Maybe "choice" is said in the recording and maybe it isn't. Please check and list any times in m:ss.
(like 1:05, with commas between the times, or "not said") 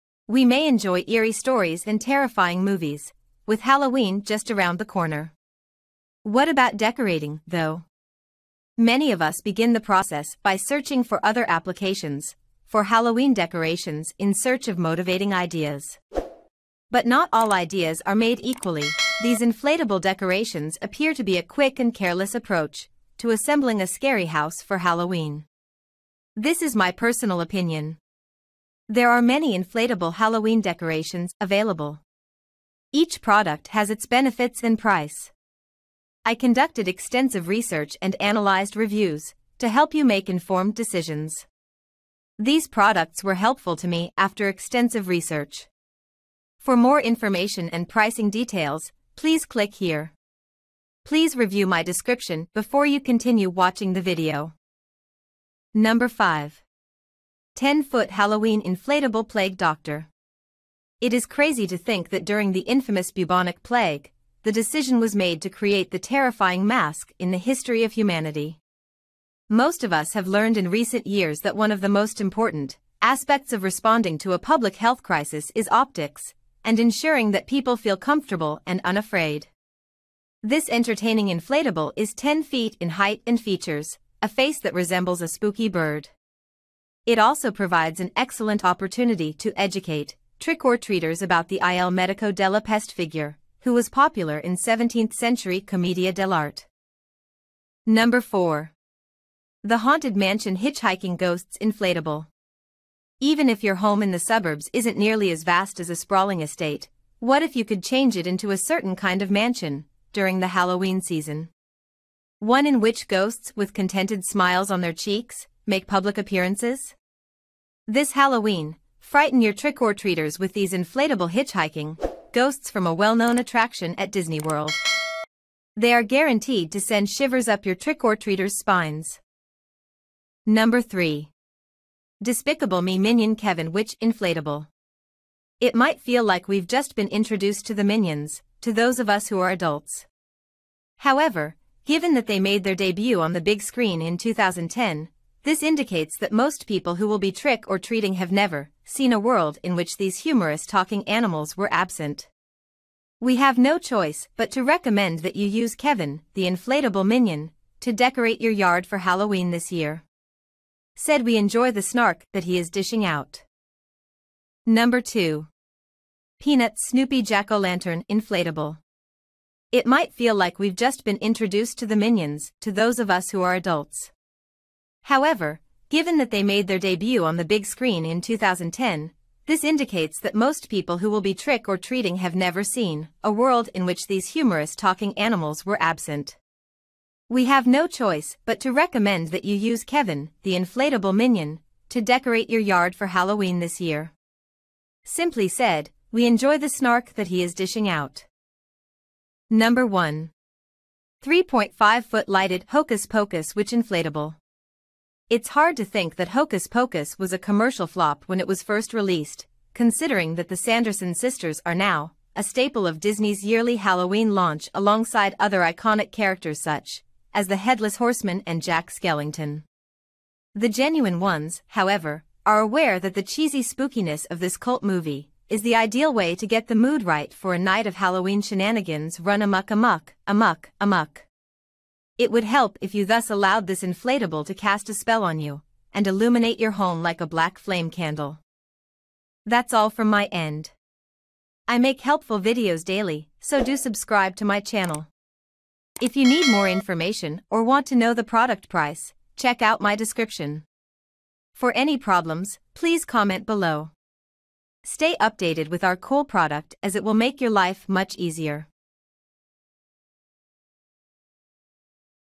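2:33, 3:07.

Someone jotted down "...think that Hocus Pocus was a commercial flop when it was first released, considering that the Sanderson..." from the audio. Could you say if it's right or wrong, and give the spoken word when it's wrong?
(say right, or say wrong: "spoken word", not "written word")
right.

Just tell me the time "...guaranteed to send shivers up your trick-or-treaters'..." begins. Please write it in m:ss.
2:06.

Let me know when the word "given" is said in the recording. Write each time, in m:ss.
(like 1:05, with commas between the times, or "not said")
2:21, 2:55.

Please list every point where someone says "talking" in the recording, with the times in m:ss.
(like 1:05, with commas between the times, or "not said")
2:30, 3:04.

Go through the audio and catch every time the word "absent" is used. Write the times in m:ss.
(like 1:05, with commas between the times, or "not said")
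2:31, 3:05.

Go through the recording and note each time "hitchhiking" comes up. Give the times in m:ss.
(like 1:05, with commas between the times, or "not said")
1:40, 2:01.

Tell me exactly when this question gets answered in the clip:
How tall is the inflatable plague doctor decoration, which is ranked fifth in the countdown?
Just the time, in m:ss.
1:22.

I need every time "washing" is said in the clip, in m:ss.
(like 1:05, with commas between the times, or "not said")
not said.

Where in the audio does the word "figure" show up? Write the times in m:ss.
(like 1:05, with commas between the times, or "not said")
1:32.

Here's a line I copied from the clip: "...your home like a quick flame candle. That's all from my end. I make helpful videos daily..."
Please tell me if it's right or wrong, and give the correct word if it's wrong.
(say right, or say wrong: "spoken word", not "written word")
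wrong: "black", not "quick".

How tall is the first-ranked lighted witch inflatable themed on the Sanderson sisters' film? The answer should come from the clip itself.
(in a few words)
3.5 feet.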